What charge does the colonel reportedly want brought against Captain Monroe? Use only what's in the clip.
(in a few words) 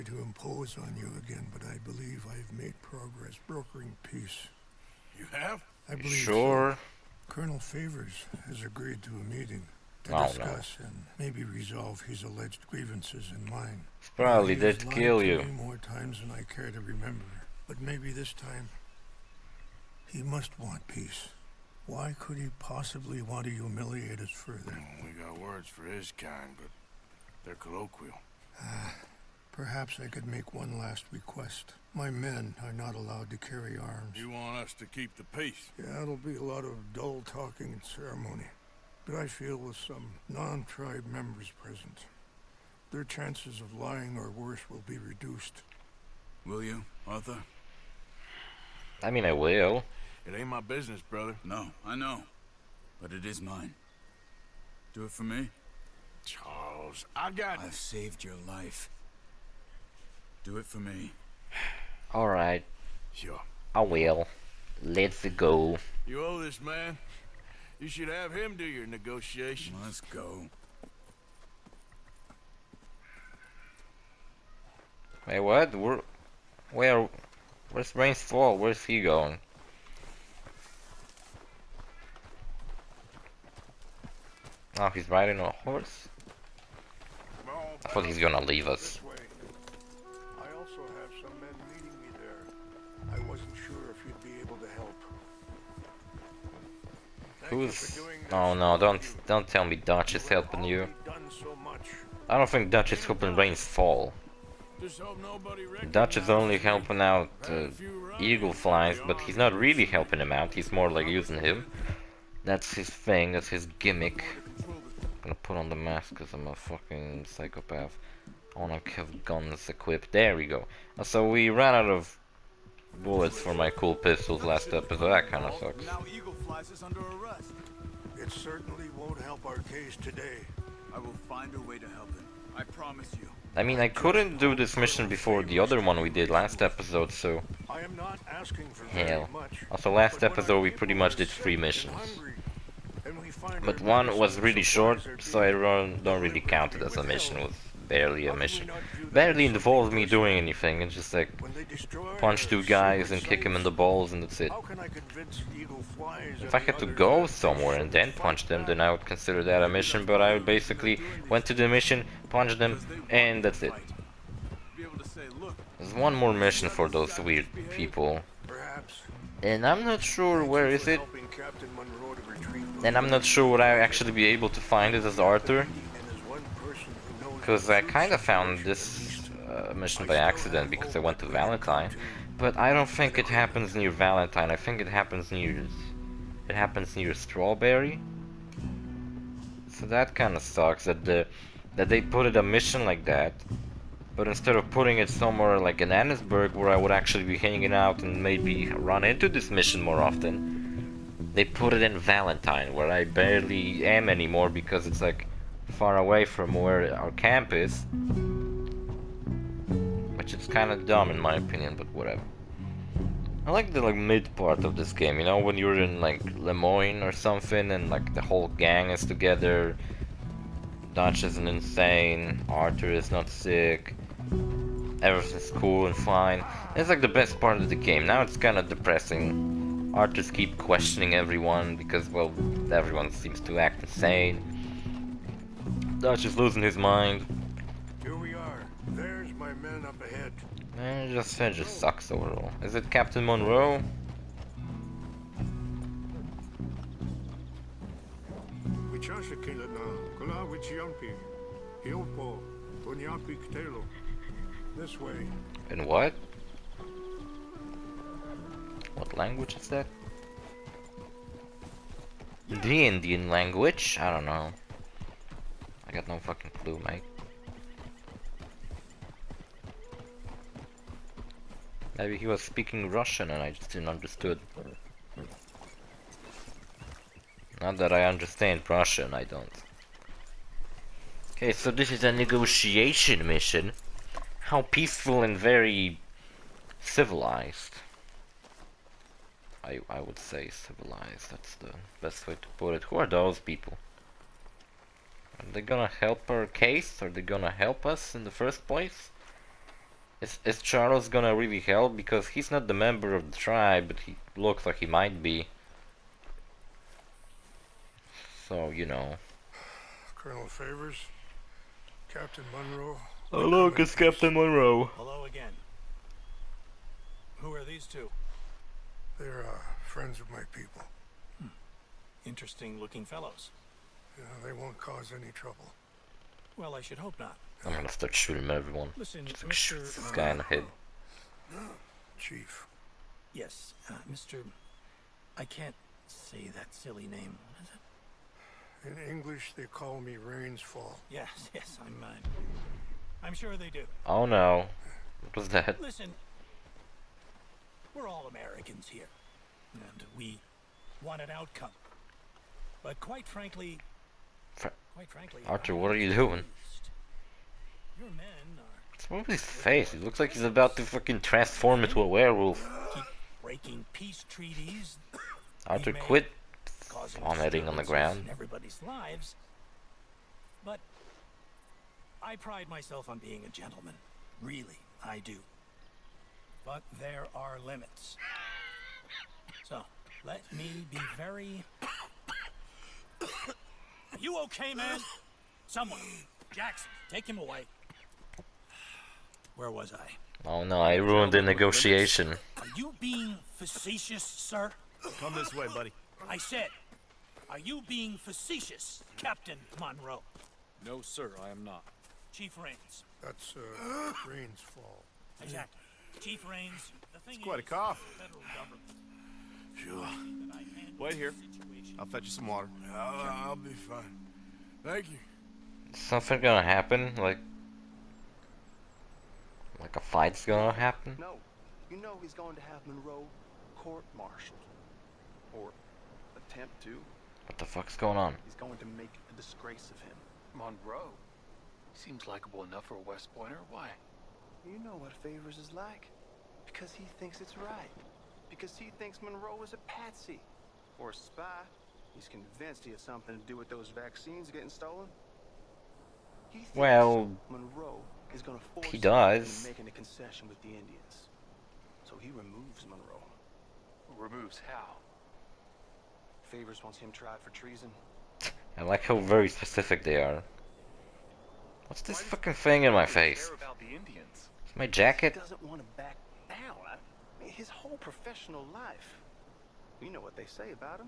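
Treason.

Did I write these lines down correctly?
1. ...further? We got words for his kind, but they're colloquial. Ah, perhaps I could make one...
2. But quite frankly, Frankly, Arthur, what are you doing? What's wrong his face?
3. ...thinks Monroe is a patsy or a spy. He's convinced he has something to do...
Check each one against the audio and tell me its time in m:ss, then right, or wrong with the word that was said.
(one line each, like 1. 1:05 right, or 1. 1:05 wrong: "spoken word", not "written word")
1. 0:24 right
2. 5:52 right
3. 7:18 right.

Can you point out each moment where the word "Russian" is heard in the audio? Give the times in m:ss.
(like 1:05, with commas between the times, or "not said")
4:32, 4:38.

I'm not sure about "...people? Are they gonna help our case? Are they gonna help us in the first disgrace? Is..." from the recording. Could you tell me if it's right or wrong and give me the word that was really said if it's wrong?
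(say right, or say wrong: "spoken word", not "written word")
wrong: "place", not "disgrace".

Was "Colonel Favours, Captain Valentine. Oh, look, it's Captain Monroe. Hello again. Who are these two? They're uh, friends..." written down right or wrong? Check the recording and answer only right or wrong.
wrong.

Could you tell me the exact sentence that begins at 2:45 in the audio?
There's one more mission for those weird people.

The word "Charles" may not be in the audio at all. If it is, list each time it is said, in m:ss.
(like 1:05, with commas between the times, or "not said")
0:56, 5:00.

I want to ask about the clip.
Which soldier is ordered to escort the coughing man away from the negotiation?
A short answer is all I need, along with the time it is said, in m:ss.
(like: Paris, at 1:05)
Jackson, at 6:26.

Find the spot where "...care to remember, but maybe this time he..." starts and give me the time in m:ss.
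0:16.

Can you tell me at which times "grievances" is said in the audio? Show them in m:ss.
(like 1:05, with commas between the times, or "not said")
0:12.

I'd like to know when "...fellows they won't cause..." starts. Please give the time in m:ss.
5:23.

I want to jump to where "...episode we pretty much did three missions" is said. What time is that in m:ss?
2:20.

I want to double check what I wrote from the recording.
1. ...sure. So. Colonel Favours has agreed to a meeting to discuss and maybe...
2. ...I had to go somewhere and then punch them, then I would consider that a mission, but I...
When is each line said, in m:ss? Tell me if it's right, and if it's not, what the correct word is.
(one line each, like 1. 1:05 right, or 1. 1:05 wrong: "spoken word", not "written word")
1. 0:06 right
2. 2:36 right.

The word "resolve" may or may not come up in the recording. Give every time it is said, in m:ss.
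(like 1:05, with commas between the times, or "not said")
0:11.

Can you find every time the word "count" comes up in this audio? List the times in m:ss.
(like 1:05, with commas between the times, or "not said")
2:26.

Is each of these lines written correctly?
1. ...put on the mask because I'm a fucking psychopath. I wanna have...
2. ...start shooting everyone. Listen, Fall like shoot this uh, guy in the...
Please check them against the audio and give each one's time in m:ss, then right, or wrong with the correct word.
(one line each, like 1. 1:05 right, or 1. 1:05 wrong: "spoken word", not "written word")
1. 1:55 right
2. 5:27 wrong: "Just", not "Fall".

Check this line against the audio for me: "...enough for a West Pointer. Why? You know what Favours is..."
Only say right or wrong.
right.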